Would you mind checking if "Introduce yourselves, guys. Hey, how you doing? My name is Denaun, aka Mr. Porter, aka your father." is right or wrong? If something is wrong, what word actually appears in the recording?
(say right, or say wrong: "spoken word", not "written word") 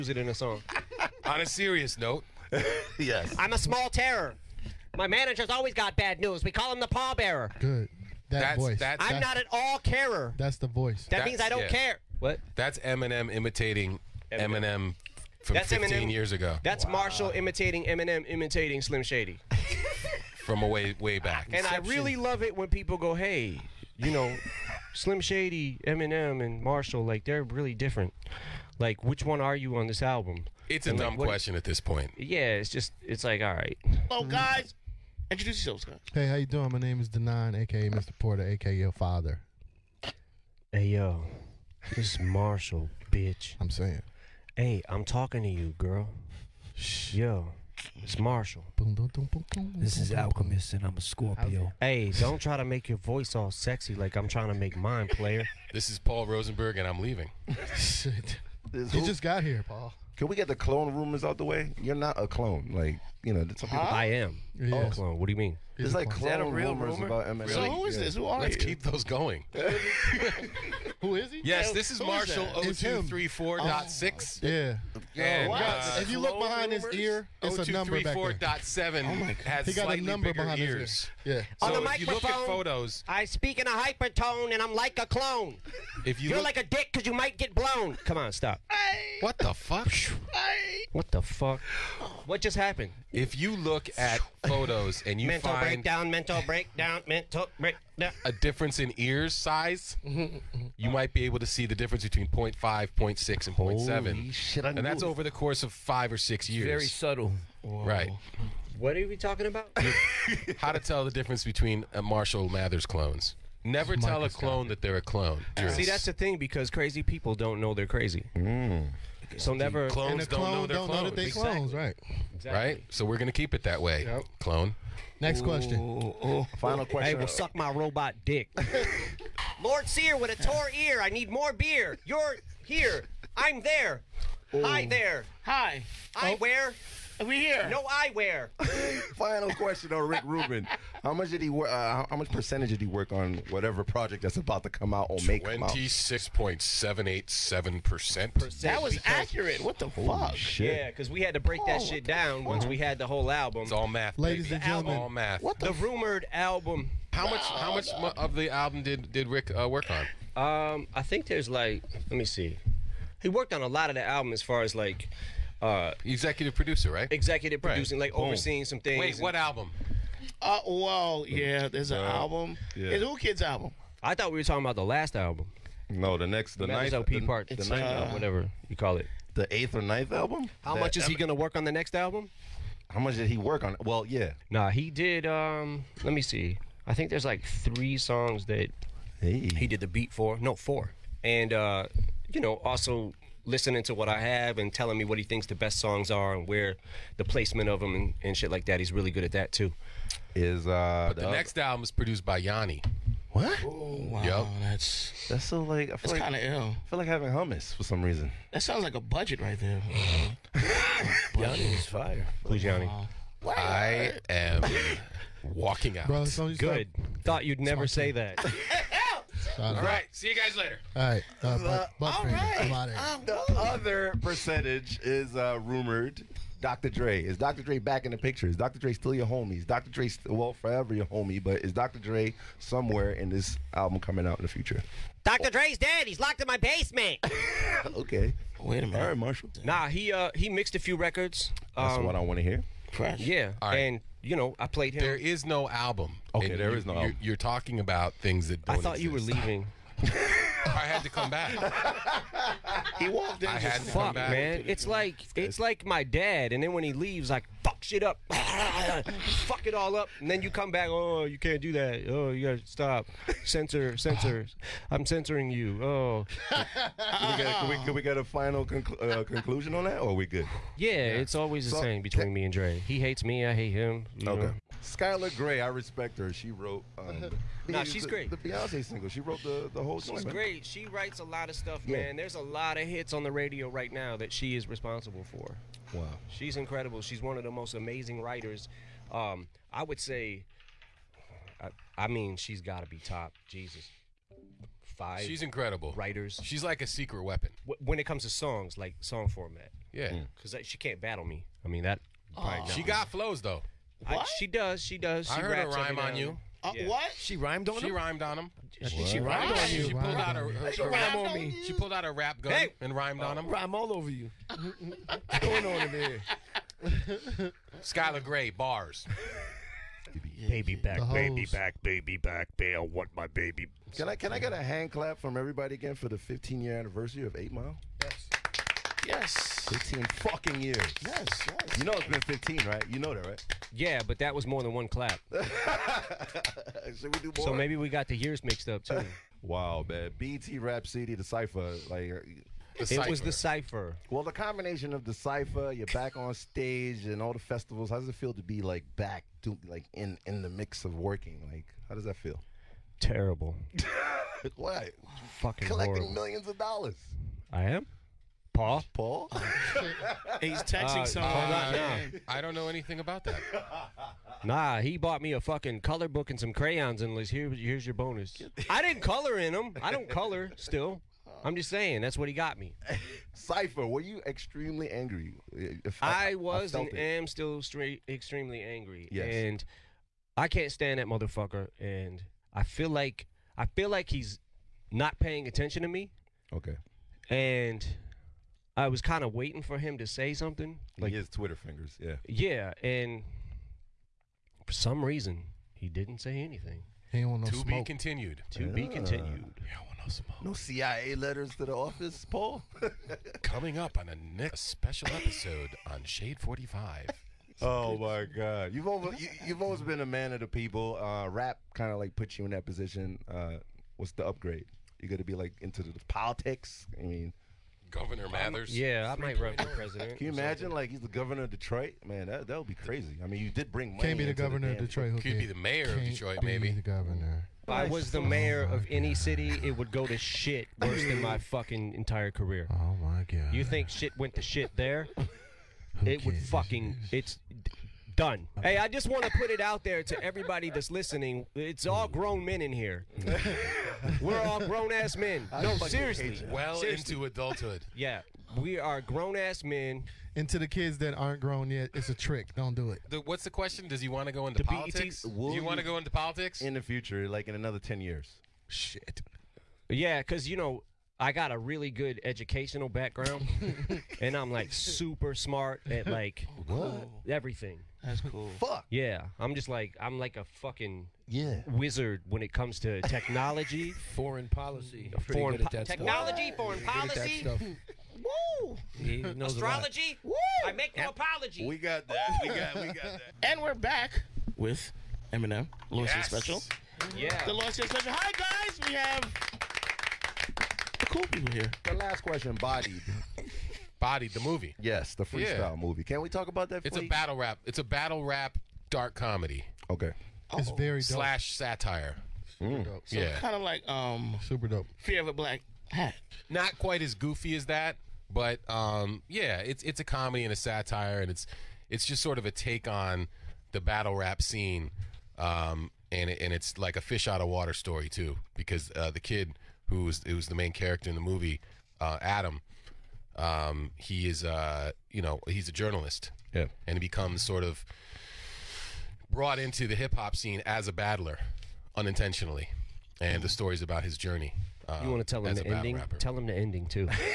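right.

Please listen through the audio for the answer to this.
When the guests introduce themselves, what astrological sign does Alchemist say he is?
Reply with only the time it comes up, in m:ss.
0:50.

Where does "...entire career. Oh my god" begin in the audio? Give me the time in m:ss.
7:11.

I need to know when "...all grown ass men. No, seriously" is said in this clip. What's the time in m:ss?
7:24.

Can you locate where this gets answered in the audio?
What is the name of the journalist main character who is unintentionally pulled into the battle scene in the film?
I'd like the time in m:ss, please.
8:42.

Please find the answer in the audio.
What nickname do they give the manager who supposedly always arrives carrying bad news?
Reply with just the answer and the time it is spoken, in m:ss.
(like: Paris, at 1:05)
The pallbearer, at 0:06.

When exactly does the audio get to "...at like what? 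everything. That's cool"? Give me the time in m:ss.
7:45.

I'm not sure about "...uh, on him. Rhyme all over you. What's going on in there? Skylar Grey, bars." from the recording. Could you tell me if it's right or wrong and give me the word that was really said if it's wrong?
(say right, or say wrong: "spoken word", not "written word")
right.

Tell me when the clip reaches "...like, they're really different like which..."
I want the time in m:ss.
0:27.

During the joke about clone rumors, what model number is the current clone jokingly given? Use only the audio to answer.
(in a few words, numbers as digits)
0234.6.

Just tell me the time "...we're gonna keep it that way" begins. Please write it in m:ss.
2:03.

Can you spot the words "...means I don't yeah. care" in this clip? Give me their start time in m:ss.
0:11.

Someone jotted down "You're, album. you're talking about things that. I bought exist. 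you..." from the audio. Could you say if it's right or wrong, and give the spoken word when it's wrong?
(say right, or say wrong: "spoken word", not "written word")
wrong: "thought", not "bought".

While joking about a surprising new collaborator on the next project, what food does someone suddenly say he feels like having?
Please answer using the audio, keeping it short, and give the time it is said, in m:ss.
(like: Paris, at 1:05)
Hummus, at 3:27.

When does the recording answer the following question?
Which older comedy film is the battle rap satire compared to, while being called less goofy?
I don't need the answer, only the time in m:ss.
8:24.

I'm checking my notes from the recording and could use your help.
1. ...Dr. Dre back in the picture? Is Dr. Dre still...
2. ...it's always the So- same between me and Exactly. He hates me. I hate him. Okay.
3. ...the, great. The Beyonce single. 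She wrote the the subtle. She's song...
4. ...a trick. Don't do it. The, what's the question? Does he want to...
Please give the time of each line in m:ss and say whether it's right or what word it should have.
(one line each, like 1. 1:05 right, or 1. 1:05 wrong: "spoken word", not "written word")
1. 3:47 right
2. 4:30 wrong: "Dre", not "Exactly"
3. 4:38 wrong: "whole", not "subtle"
4. 7:32 right.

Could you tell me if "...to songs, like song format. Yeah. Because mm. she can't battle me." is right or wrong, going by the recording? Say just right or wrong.
right.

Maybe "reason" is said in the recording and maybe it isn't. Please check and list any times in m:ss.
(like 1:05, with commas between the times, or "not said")
3:28, 6:35.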